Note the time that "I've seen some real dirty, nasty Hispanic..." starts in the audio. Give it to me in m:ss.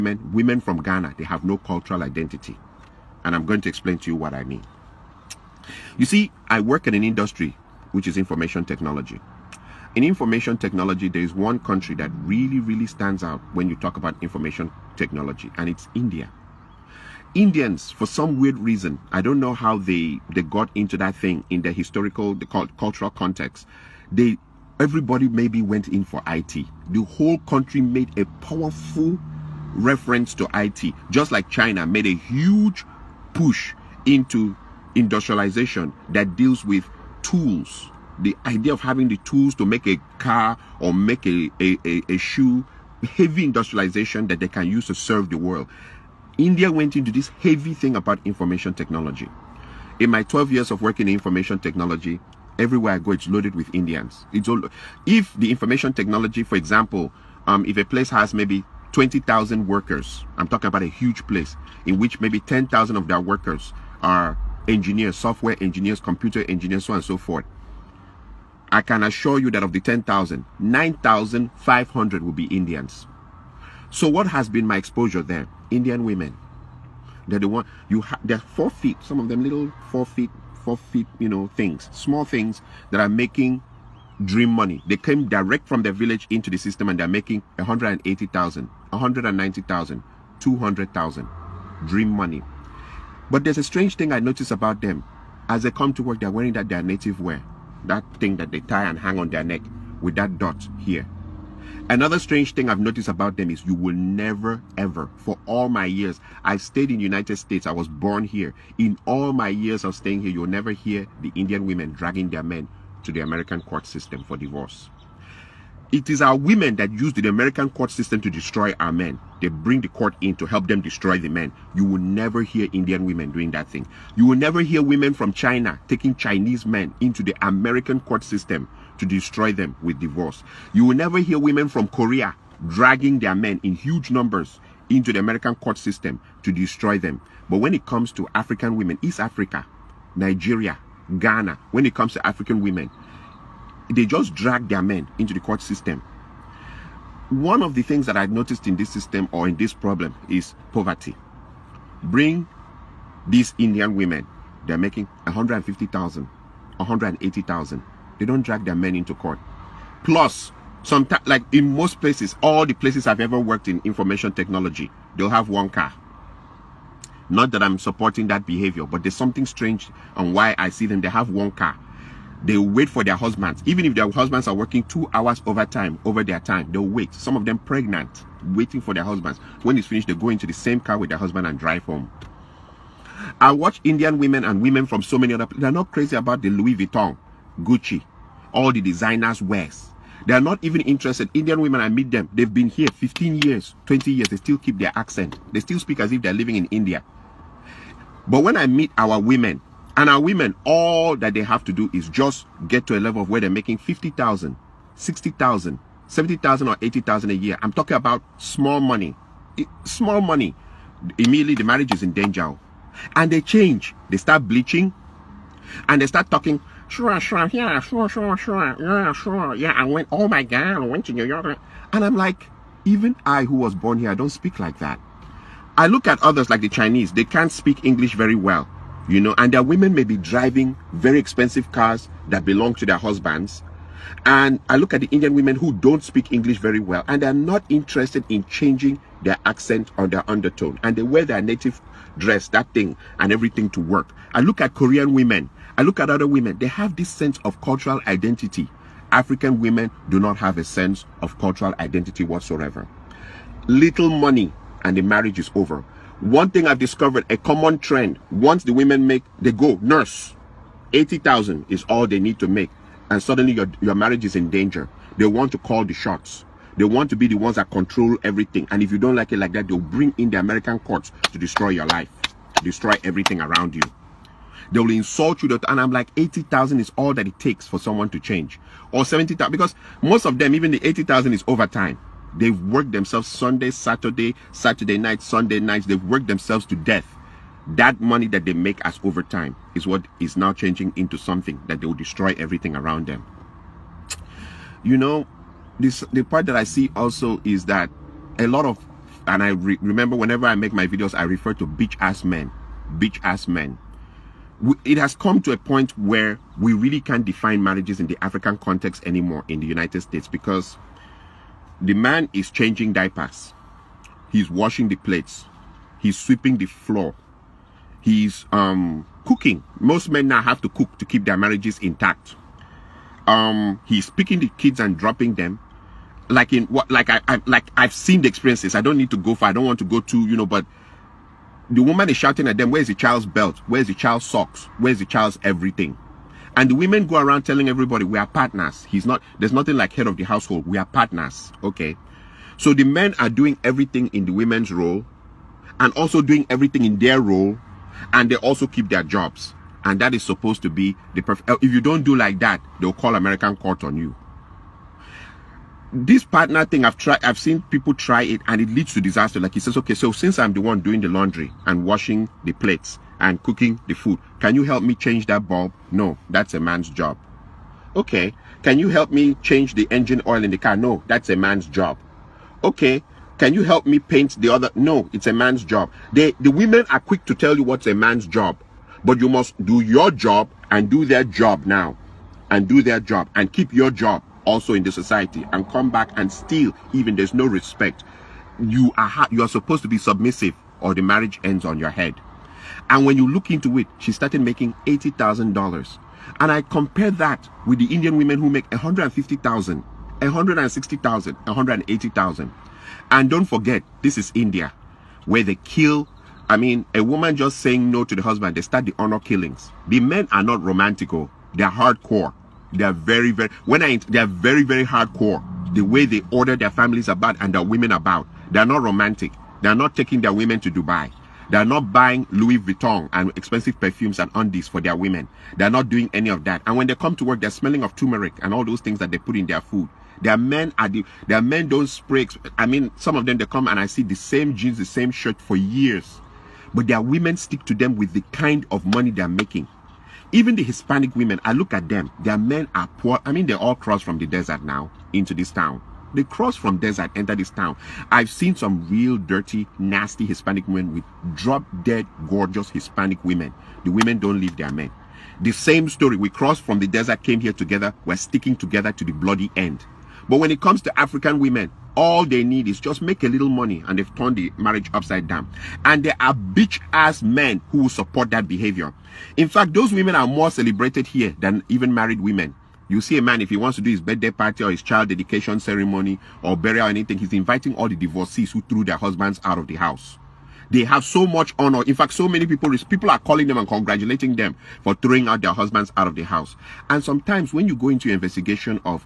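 7:28.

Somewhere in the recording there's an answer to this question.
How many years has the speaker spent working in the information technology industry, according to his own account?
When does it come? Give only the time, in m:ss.
0:50.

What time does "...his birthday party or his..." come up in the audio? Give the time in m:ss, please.
7:53.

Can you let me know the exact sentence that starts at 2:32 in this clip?
Bring these Indian women, they're making 150,000, 180,000.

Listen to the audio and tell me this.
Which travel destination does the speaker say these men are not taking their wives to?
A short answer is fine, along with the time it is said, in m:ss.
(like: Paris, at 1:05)
Dubai, at 7:00.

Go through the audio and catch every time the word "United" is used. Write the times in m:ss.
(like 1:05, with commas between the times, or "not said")
1:46, 5:09.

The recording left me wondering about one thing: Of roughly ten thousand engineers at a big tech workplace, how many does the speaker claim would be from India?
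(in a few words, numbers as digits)
9,500.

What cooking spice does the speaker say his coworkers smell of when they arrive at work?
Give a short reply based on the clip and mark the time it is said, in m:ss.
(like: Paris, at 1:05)
turmeric, at 7:07.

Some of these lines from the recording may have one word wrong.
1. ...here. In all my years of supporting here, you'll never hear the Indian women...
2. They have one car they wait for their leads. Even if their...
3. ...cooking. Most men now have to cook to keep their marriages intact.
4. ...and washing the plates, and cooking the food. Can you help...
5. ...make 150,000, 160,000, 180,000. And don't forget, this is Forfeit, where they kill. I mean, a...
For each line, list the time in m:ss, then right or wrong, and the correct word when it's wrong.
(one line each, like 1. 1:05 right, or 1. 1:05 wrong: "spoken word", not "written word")
1. 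1:48 wrong: "staying", not "supporting"
2. 2:50 wrong: "husbands", not "leads"
3. 5:19 right
4. 6:01 right
5. 6:38 wrong: "India", not "Forfeit".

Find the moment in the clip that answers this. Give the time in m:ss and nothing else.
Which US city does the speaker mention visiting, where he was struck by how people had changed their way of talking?
3:41.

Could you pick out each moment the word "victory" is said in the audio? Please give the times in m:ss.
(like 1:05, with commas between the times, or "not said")
not said.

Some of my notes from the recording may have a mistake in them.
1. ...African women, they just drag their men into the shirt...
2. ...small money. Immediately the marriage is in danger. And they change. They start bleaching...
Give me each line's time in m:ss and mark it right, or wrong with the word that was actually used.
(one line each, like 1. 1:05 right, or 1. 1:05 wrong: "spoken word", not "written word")
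1. 2:22 wrong: "court", not "shirt"
2. 3:29 right.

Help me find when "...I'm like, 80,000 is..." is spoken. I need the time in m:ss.
4:35.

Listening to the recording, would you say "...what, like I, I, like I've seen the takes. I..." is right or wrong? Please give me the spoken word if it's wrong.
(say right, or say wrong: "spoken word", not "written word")
wrong: "experiences", not "takes".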